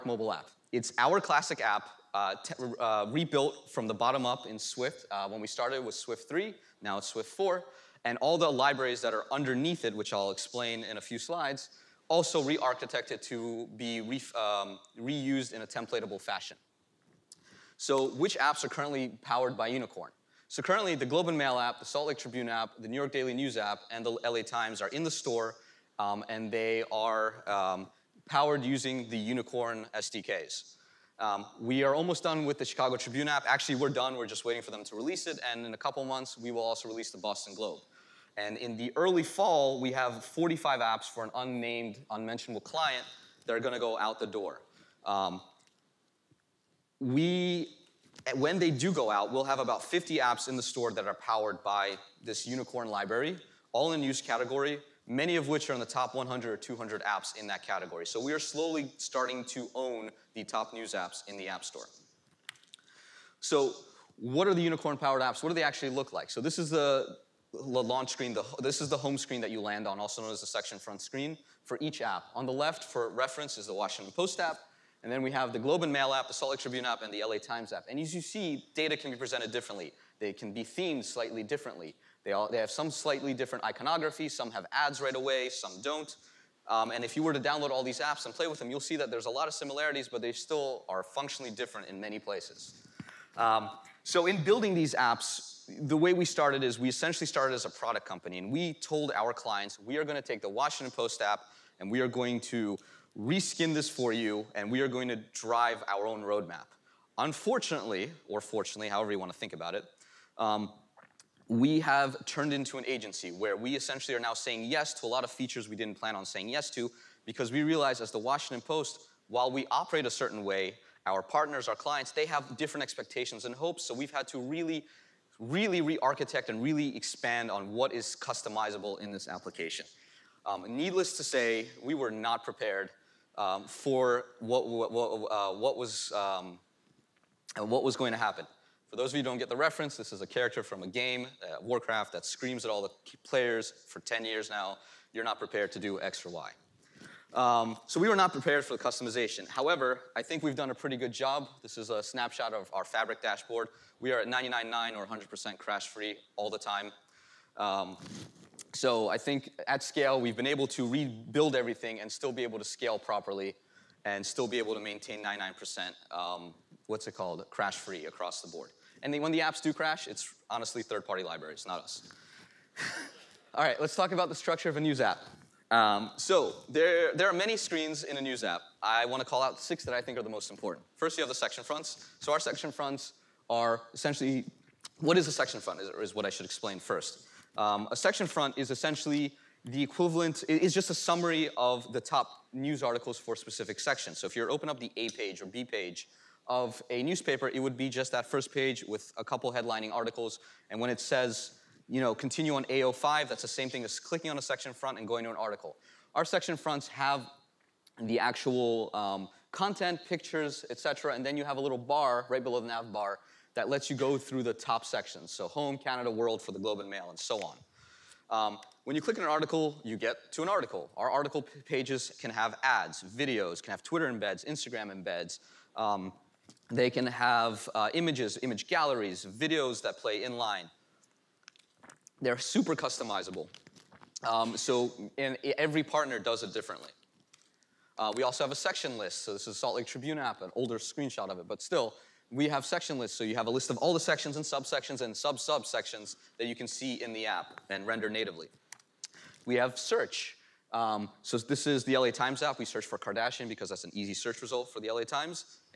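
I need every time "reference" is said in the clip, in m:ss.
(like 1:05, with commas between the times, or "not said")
1:13, 2:19.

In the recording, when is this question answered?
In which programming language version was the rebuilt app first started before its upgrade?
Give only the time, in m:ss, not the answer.
0:05.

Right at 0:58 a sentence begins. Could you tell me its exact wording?
So we are slowly starting to own the top news apps in the App Store.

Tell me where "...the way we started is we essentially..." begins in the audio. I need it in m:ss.
1:35.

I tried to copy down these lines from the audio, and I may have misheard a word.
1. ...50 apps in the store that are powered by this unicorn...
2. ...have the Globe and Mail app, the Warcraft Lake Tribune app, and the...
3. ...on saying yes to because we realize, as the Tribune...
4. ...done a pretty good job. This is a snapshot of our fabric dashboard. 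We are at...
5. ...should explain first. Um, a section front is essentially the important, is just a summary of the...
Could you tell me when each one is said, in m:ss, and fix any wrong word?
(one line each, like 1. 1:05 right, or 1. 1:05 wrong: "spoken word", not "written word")
1. 0:49 right
2. 1:15 wrong: "Salt", not "Warcraft"
3. 1:56 wrong: "Washington", not "Tribune"
4. 2:30 right
5. 3:06 wrong: "equivalent", not "important".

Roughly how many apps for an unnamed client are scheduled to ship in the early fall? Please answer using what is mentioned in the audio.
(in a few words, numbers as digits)
45.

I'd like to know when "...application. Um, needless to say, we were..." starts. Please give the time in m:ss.
2:09.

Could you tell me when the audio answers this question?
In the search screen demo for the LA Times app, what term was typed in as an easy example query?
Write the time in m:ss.
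4:12.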